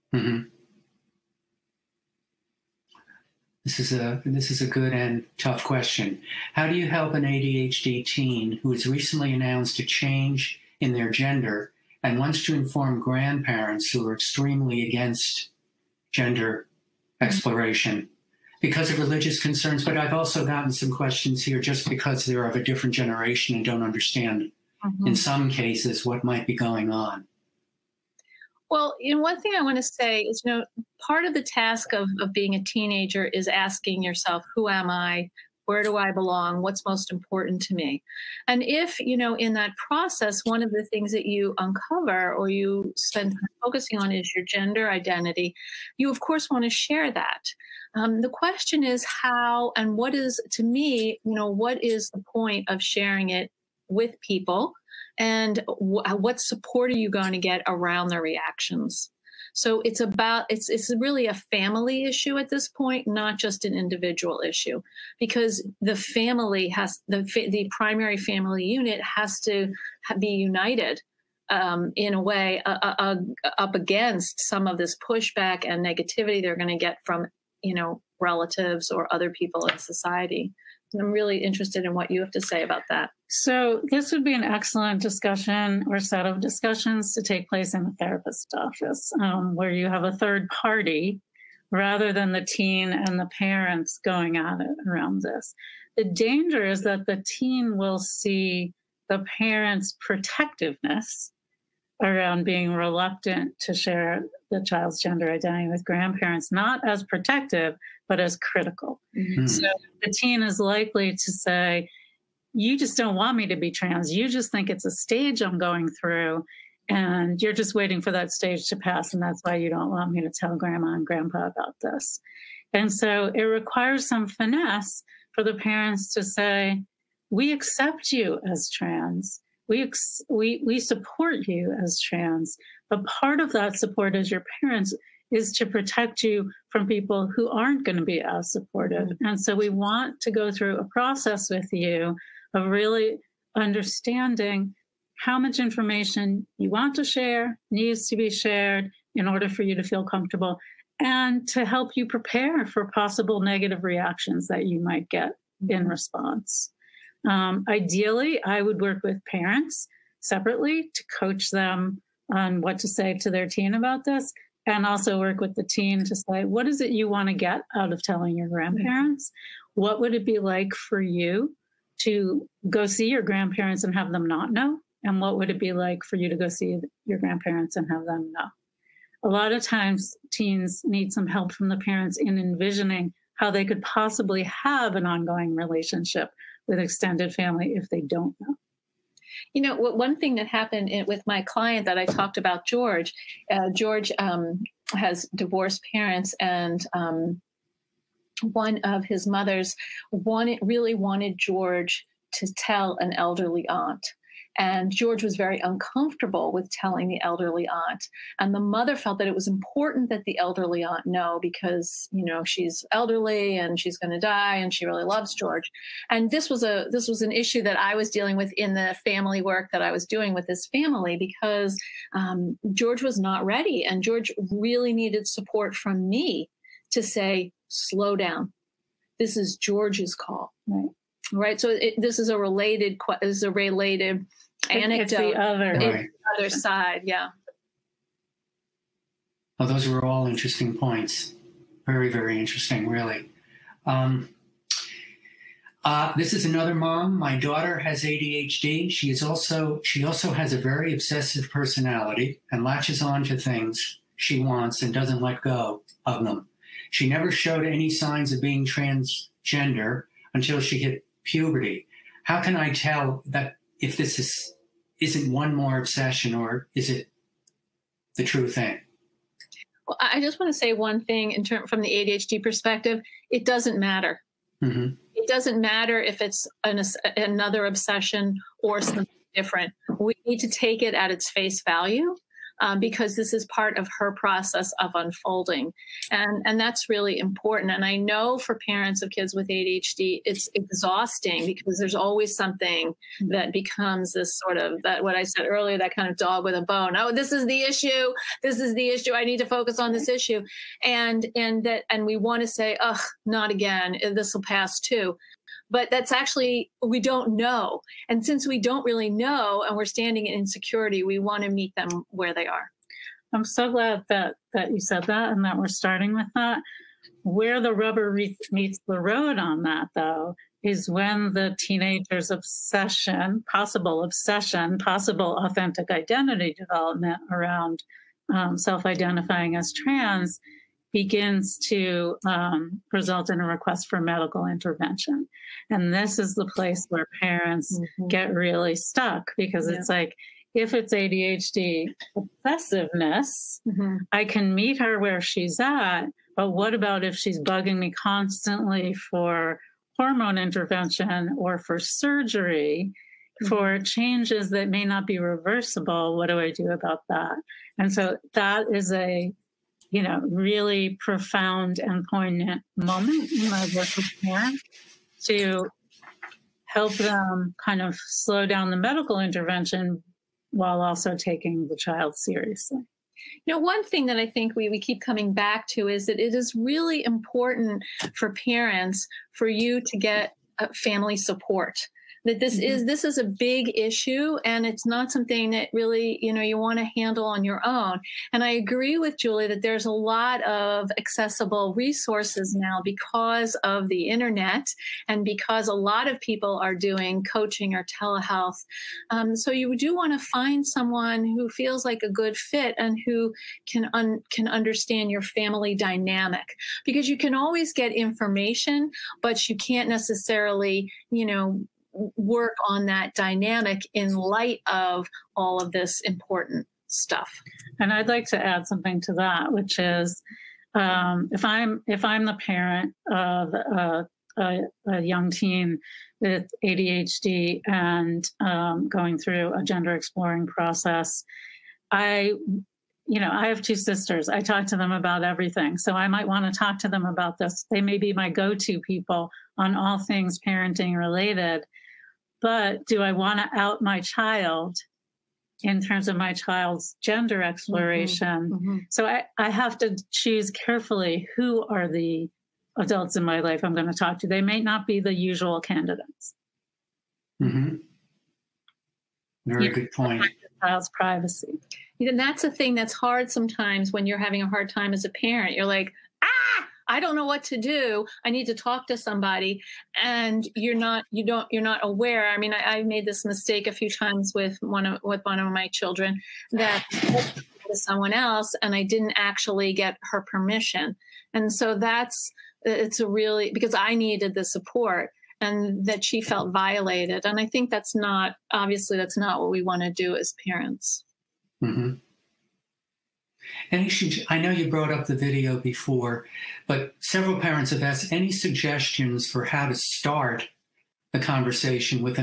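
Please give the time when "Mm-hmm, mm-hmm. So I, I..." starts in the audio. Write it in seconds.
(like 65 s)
448 s.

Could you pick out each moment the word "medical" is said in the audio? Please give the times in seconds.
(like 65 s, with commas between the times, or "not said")
333 s, 368 s.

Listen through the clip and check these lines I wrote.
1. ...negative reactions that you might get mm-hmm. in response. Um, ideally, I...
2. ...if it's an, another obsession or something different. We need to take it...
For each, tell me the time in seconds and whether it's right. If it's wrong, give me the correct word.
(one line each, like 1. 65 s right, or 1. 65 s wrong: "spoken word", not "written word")
1. 153 s right
2. 275 s right.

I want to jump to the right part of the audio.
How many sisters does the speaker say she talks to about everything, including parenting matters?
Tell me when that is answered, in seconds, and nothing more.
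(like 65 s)
433 s.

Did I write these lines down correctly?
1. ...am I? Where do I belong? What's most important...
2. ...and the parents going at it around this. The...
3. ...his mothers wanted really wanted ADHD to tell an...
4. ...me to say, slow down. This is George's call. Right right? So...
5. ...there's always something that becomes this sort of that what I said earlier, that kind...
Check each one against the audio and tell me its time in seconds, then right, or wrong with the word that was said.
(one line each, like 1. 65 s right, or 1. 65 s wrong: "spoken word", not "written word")
1. 34 s right
2. 92 s right
3. 199 s wrong: "George", not "ADHD"
4. 226 s right
5. 291 s right.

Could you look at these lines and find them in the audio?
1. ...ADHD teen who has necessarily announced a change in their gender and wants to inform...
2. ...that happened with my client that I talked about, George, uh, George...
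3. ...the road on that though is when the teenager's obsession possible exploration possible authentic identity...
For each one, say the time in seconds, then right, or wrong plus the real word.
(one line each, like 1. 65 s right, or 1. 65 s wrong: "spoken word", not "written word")
1. 7 s wrong: "recently", not "necessarily"
2. 190 s right
3. 318 s wrong: "obsession", not "exploration".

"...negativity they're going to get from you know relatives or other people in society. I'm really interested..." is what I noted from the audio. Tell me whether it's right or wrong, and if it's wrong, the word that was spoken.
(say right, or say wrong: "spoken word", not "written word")
right.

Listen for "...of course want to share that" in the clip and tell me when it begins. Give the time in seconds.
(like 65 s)
46 s.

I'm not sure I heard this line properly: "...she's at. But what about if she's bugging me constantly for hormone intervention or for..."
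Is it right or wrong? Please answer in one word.
right.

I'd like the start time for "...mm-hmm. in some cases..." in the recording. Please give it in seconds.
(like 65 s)
24 s.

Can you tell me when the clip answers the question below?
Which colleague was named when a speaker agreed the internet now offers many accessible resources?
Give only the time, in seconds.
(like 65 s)
389 s.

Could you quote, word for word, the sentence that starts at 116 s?
And you're just waiting for that stage to pass.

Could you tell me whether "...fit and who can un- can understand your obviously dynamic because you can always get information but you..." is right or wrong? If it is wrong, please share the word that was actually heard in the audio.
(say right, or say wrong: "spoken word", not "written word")
wrong: "family", not "obviously".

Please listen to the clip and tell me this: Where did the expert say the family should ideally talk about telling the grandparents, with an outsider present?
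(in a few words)
the therapist's office.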